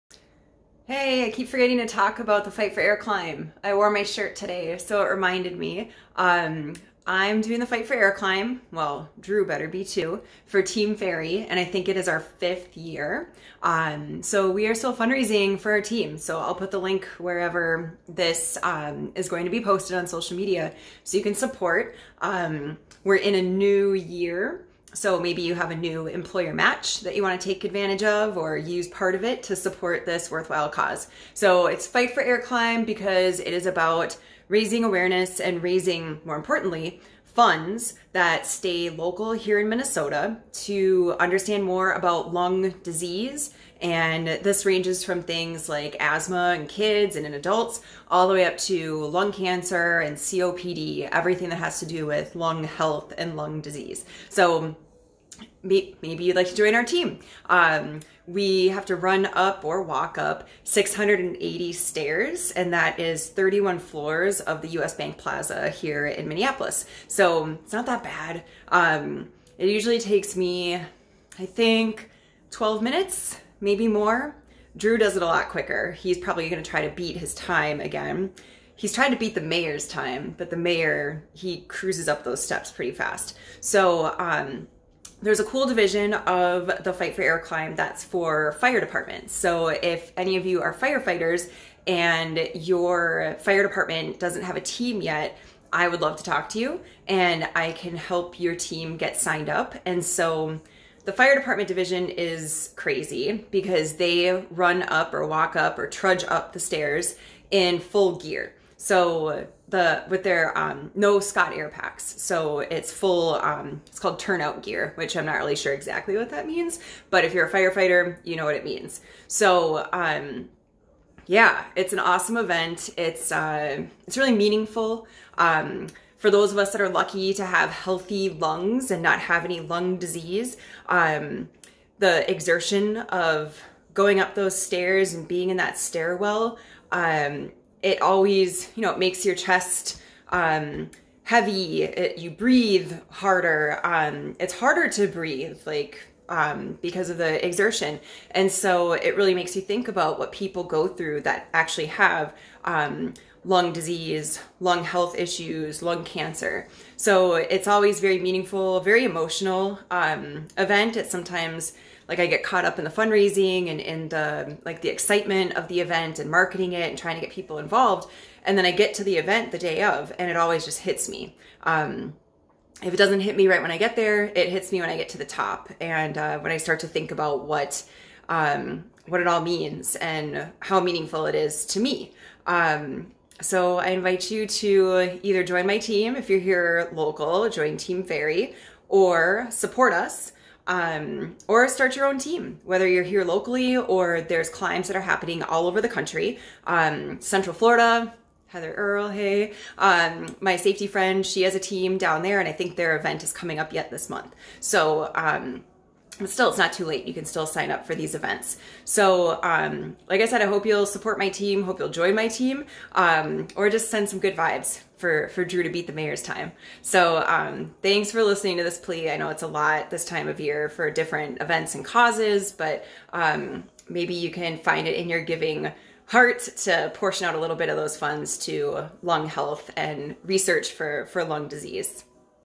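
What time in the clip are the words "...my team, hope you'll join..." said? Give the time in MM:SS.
03:31.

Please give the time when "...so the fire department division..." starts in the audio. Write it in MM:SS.
01:40.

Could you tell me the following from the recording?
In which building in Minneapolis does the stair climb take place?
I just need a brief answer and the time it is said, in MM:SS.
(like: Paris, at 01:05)
US Bank Plaza, at 01:04.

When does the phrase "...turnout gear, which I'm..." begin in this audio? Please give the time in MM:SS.
01:54.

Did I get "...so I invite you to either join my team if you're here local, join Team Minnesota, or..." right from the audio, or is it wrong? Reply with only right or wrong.
wrong.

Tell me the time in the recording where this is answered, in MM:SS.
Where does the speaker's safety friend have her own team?
03:17.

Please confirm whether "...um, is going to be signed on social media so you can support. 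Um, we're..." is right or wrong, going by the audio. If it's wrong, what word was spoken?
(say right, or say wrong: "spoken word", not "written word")
wrong: "posted", not "signed".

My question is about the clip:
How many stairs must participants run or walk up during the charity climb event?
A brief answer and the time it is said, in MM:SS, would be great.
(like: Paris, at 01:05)
680, at 01:00.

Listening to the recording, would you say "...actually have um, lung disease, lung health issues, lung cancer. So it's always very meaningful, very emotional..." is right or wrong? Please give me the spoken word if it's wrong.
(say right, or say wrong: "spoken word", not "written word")
right.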